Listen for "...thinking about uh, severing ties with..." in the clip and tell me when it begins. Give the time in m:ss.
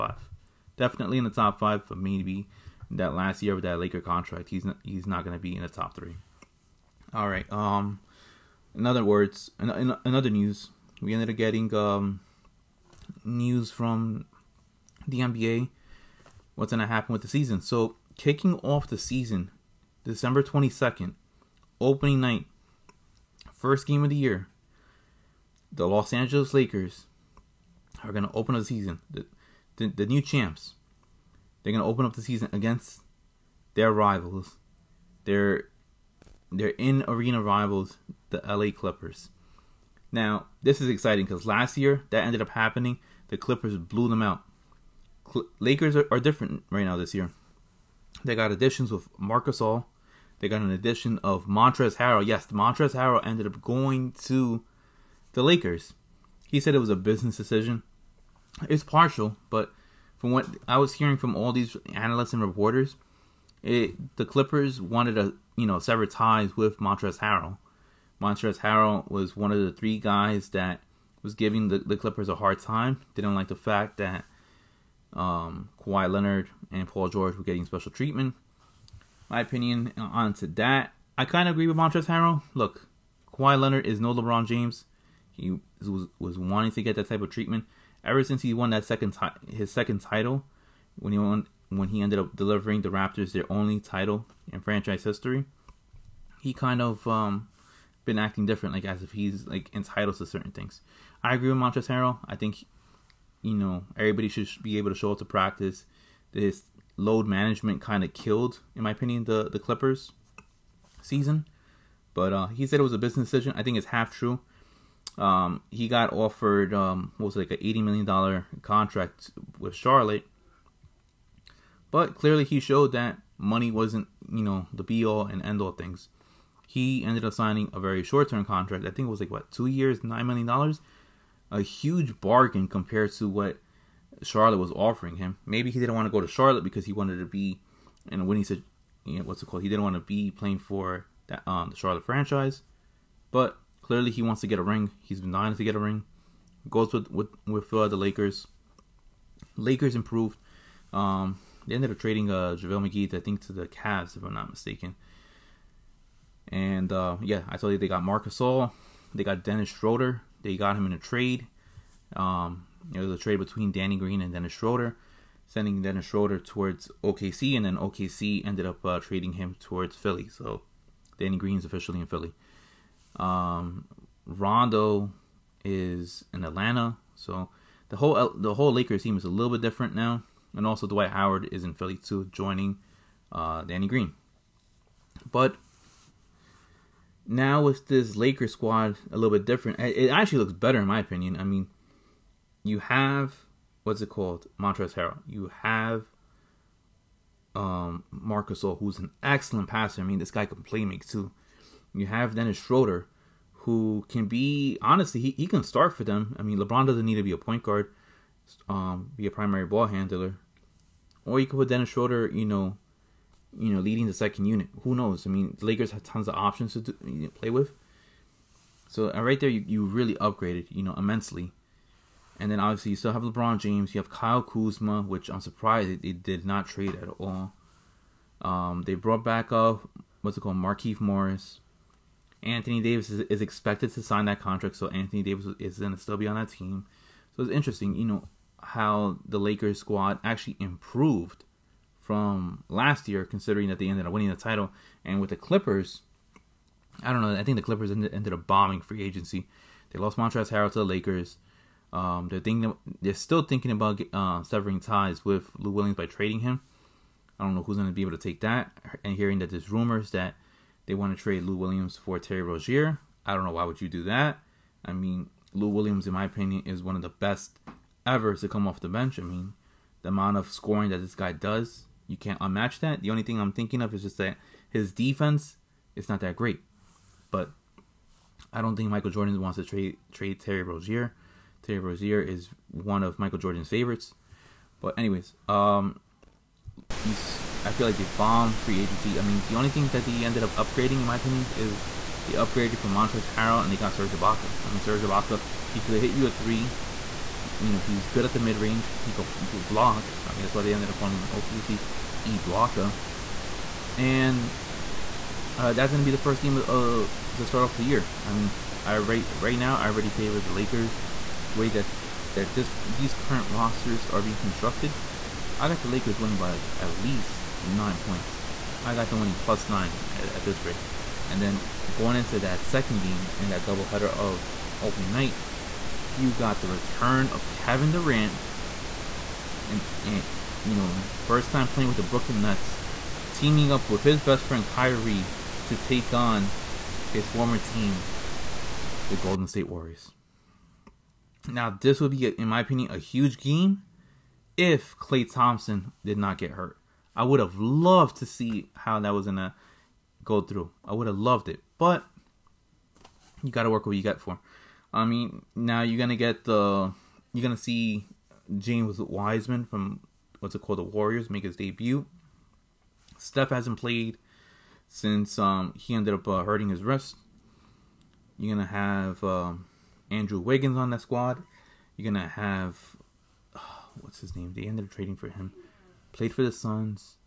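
4:13.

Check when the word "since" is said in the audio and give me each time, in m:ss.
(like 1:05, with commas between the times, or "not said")
1:28, 6:04.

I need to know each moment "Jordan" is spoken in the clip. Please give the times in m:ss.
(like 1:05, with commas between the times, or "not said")
4:39, 4:43.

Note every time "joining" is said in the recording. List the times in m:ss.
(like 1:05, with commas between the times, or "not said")
3:02.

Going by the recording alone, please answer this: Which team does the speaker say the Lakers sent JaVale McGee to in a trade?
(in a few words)
Cavs.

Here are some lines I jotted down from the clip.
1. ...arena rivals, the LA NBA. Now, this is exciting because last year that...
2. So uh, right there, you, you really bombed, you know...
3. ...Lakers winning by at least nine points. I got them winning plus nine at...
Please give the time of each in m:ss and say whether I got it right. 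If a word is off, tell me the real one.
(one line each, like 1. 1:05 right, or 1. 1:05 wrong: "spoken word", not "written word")
1. 0:37 wrong: "Clippers", not "NBA"
2. 3:38 wrong: "upgraded", not "bombed"
3. 5:15 right.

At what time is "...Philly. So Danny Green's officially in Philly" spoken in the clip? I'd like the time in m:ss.
2:49.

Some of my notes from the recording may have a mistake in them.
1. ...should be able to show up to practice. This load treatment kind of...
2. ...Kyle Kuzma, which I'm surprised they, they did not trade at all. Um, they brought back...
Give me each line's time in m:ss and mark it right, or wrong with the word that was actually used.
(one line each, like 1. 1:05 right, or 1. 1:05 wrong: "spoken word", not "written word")
1. 1:44 wrong: "management", not "treatment"
2. 3:44 right.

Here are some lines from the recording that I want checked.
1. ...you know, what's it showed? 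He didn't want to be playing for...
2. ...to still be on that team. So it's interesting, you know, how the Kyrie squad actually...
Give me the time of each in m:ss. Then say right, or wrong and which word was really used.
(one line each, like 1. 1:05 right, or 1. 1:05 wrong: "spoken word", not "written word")
1. 2:19 wrong: "called", not "showed"
2. 3:55 wrong: "Lakers", not "Kyrie".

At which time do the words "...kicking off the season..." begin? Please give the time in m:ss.
0:18.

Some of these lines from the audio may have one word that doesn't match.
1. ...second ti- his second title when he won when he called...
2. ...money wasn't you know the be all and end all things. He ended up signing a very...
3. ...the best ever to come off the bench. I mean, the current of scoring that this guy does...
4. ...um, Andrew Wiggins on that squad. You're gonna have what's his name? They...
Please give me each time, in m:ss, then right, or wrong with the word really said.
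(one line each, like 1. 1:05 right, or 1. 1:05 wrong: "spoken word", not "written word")
1. 1:28 wrong: "ended", not "called"
2. 2:03 right
3. 4:27 wrong: "amount", not "current"
4. 6:09 right.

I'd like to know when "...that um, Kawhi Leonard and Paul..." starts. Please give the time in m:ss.
1:13.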